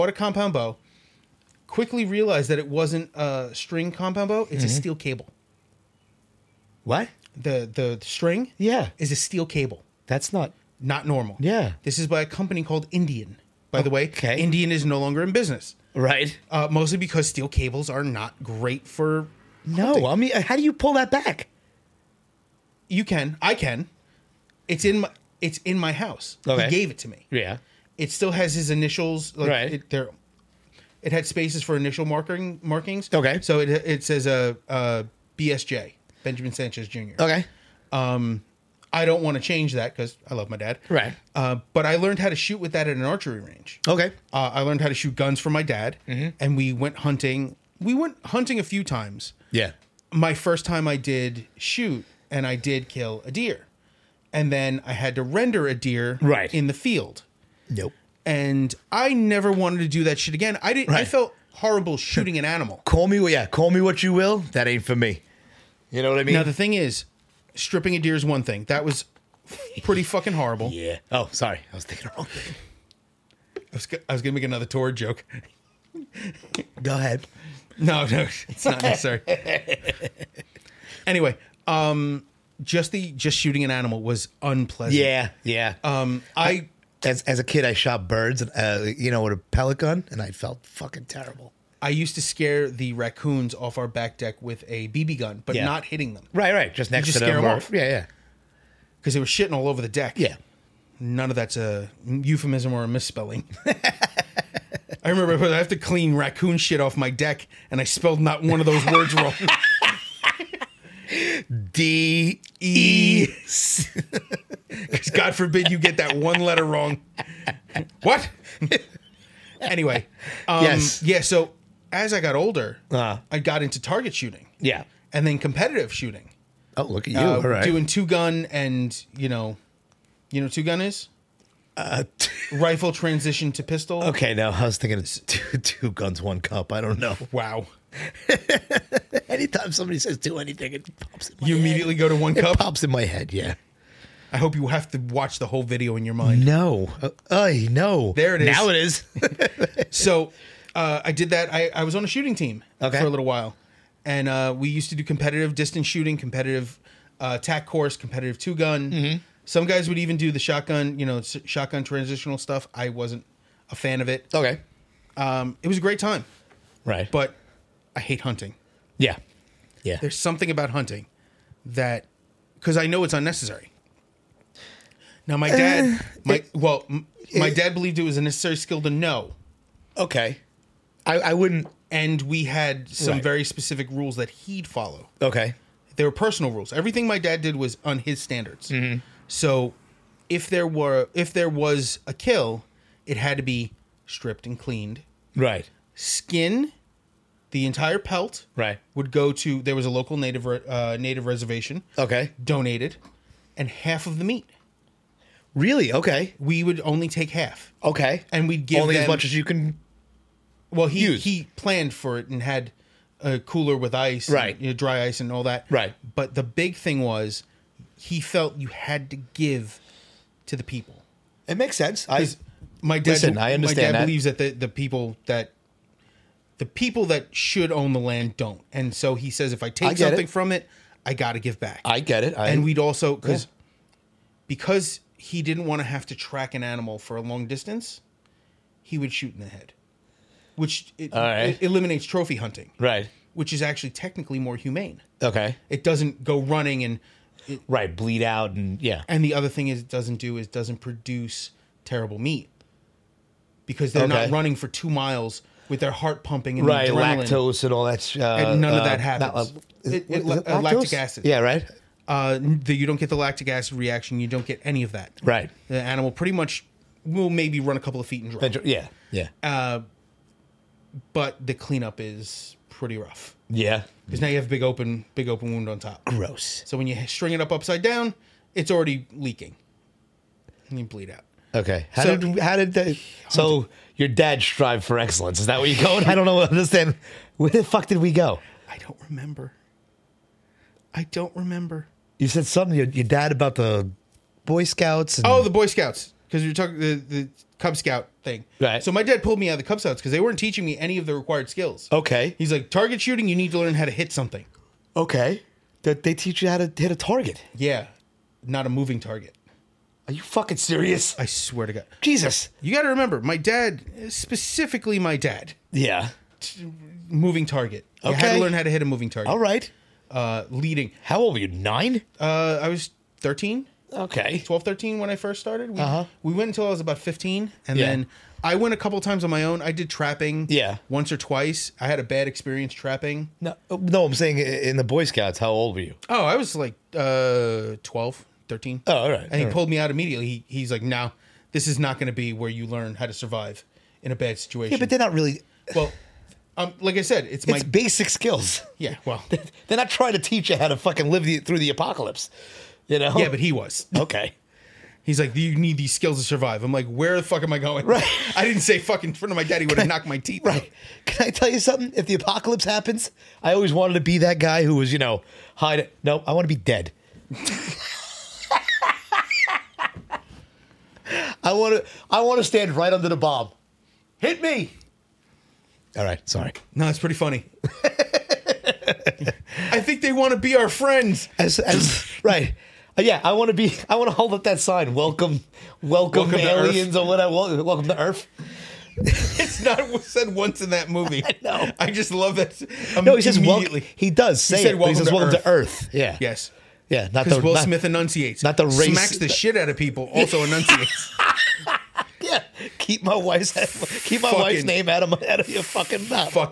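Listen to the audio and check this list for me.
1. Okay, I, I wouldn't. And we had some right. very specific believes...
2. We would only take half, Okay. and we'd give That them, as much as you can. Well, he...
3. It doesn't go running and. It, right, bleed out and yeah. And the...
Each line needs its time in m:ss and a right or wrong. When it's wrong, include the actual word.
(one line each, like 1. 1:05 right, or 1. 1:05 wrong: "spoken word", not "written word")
1. 2:59 wrong: "rules", not "believes"
2. 3:26 wrong: "Only", not "That"
3. 4:05 right.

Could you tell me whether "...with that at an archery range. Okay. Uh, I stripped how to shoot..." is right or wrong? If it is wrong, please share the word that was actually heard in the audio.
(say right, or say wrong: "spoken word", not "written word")
wrong: "learned", not "stripped".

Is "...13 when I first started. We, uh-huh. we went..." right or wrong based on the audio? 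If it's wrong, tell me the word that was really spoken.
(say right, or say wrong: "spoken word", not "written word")
right.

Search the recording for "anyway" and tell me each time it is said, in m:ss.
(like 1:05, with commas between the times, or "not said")
1:21, 1:59.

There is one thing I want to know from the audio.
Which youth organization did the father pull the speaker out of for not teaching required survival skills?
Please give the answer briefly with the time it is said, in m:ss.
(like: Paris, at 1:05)
Cub Scouts, at 4:59.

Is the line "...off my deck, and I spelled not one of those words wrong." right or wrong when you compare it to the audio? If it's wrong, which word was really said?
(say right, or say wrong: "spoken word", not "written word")
right.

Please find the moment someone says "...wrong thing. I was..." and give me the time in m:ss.
1:12.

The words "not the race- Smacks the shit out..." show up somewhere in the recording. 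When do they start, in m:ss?
6:38.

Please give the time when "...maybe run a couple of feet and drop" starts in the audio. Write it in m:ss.
4:27.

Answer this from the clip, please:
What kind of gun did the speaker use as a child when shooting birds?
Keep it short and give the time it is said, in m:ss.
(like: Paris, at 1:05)
pellet gun, at 1:29.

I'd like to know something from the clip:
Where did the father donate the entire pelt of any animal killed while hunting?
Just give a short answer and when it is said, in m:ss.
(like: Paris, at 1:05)
native reservation, at 3:20.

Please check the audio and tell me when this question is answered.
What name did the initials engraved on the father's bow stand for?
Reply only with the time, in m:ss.
0:36.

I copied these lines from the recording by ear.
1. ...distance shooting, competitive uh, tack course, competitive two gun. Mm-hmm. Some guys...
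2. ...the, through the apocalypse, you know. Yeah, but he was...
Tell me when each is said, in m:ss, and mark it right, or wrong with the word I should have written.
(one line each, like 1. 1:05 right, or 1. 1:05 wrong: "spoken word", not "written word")
1. 2:35 right
2. 5:51 right.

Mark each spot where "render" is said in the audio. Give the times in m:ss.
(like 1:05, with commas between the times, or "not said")
0:55.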